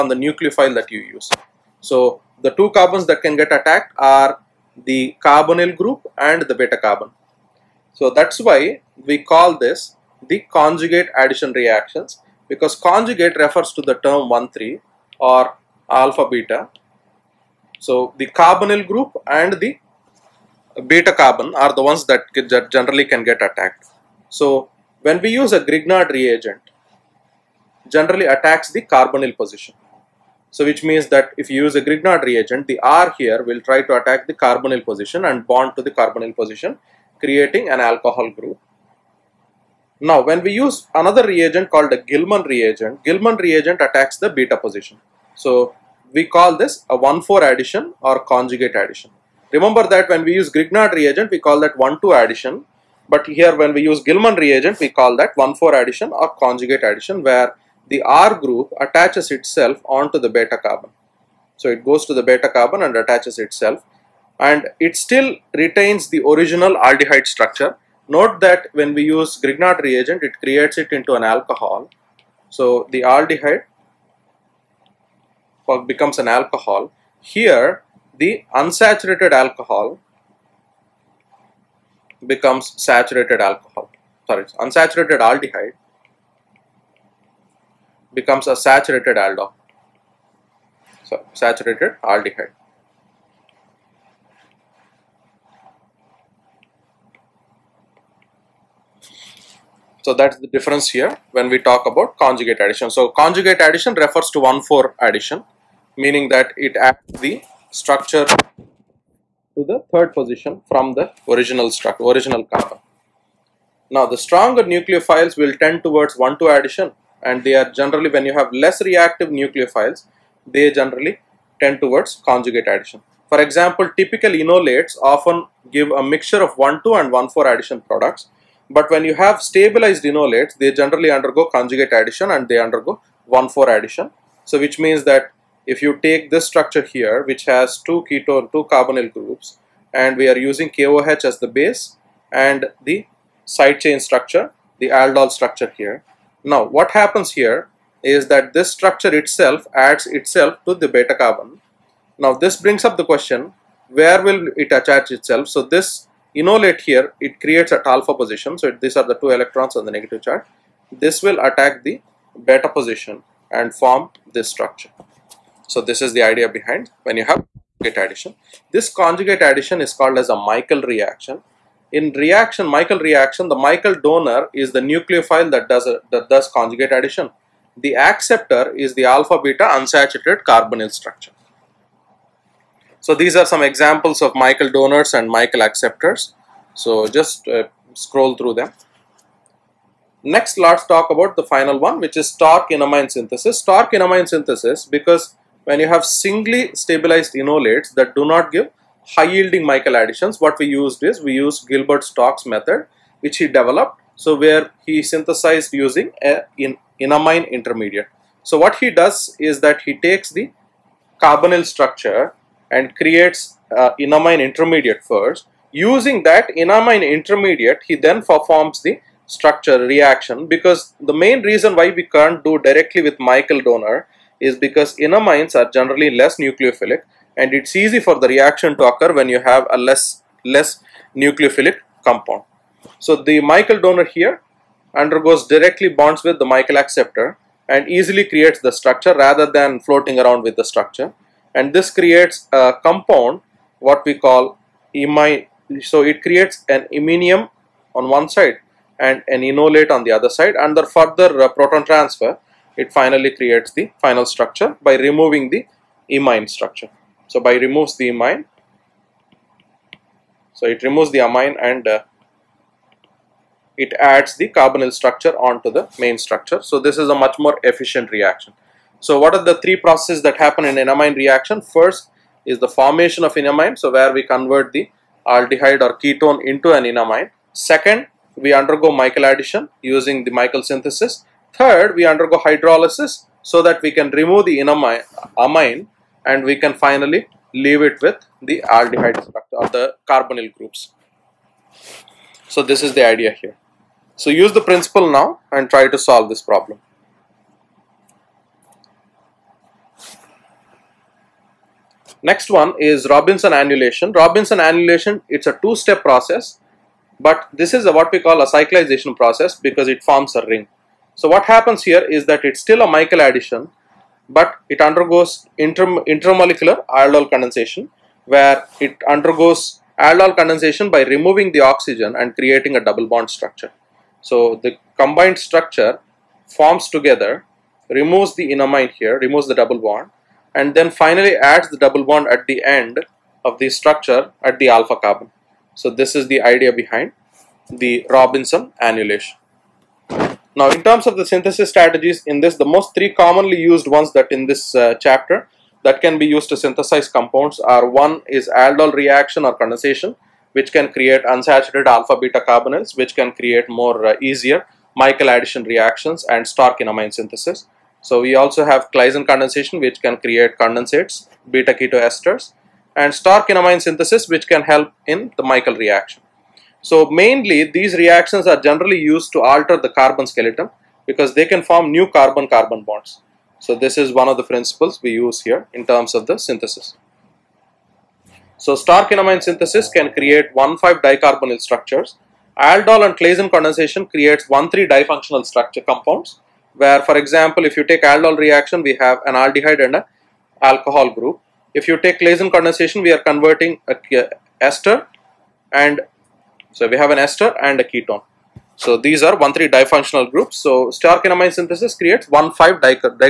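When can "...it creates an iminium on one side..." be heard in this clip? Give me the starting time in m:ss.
4:06.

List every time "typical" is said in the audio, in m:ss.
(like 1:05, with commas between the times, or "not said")
2:03.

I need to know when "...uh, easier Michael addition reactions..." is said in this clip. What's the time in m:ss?
5:54.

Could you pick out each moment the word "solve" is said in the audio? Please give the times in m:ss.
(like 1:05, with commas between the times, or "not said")
4:55.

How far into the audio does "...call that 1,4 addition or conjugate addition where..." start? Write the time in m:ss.
0:54.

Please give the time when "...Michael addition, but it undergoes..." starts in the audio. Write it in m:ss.
5:12.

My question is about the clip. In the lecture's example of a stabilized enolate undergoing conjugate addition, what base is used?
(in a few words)
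KOH.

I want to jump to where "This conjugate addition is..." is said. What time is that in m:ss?
2:48.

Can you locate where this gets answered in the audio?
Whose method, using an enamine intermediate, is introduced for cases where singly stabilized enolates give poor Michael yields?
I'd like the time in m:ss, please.
3:21.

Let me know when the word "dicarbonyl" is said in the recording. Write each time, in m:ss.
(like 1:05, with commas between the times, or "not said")
6:20.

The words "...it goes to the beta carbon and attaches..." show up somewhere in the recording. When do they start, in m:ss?
1:01.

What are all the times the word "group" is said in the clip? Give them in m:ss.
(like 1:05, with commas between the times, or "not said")
0:05, 0:18, 0:38, 0:58, 2:19, 4:50, 6:31, 6:40.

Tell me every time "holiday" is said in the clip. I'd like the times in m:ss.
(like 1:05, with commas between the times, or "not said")
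not said.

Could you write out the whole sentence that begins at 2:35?
So this enolate here it creates at alpha position so it, these are the two electrons on the negative charge.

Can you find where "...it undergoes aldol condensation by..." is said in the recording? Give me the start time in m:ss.
5:18.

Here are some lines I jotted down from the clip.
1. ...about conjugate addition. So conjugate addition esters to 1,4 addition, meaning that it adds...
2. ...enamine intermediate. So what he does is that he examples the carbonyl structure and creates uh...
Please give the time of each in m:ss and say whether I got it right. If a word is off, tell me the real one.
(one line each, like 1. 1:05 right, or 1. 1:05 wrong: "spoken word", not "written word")
1. 1:41 wrong: "refers", not "esters"
2. 3:26 wrong: "takes", not "examples".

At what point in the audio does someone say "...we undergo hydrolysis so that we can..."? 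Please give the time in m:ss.
4:41.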